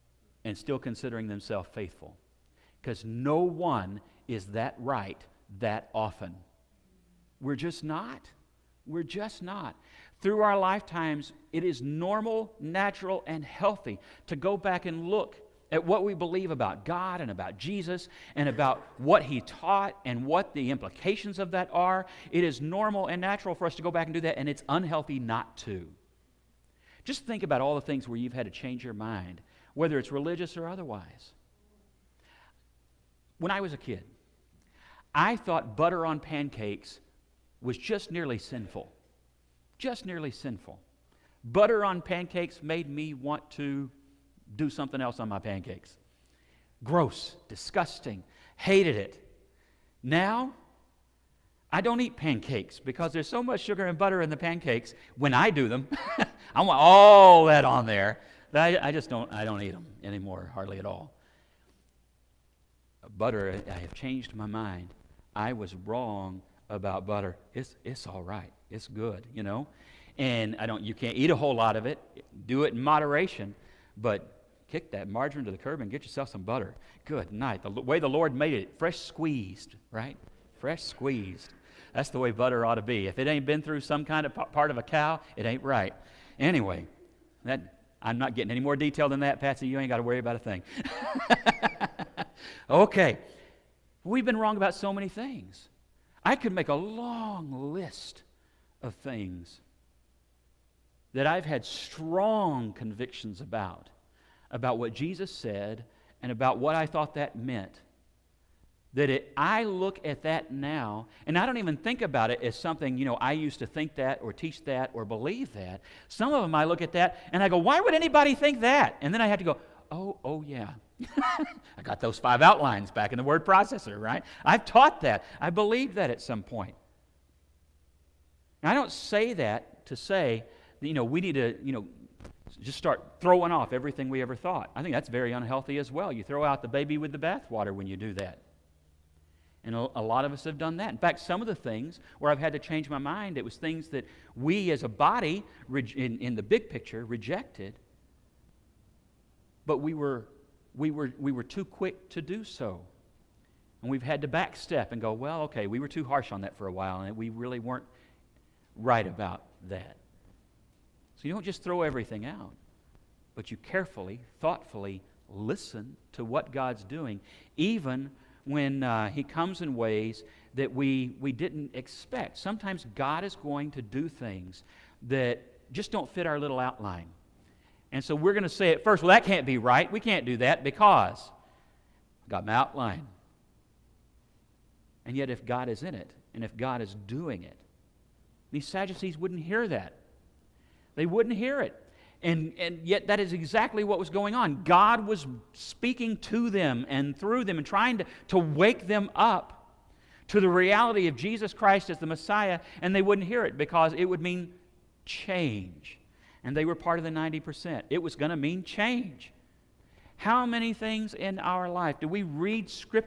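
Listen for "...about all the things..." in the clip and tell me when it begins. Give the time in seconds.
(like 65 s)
27 s.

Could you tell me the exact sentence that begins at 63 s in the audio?
Butter, I have changed my mind.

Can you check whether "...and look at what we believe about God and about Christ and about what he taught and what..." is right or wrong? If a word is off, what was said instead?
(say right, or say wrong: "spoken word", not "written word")
wrong: "Jesus", not "Christ".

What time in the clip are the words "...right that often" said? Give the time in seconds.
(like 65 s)
4 s.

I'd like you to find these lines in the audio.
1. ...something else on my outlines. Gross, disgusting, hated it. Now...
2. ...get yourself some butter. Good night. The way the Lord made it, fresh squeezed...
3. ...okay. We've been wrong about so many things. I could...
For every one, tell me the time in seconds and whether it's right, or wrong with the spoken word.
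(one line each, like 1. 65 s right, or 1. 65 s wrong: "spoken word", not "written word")
1. 44 s wrong: "pancakes", not "outlines"
2. 75 s right
3. 92 s right.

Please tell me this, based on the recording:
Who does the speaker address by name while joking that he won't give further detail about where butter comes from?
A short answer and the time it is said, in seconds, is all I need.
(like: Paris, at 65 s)
Patsy, at 89 s.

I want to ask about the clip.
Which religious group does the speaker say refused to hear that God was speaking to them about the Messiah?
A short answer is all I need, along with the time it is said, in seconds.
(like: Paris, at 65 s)
Sadducees, at 188 s.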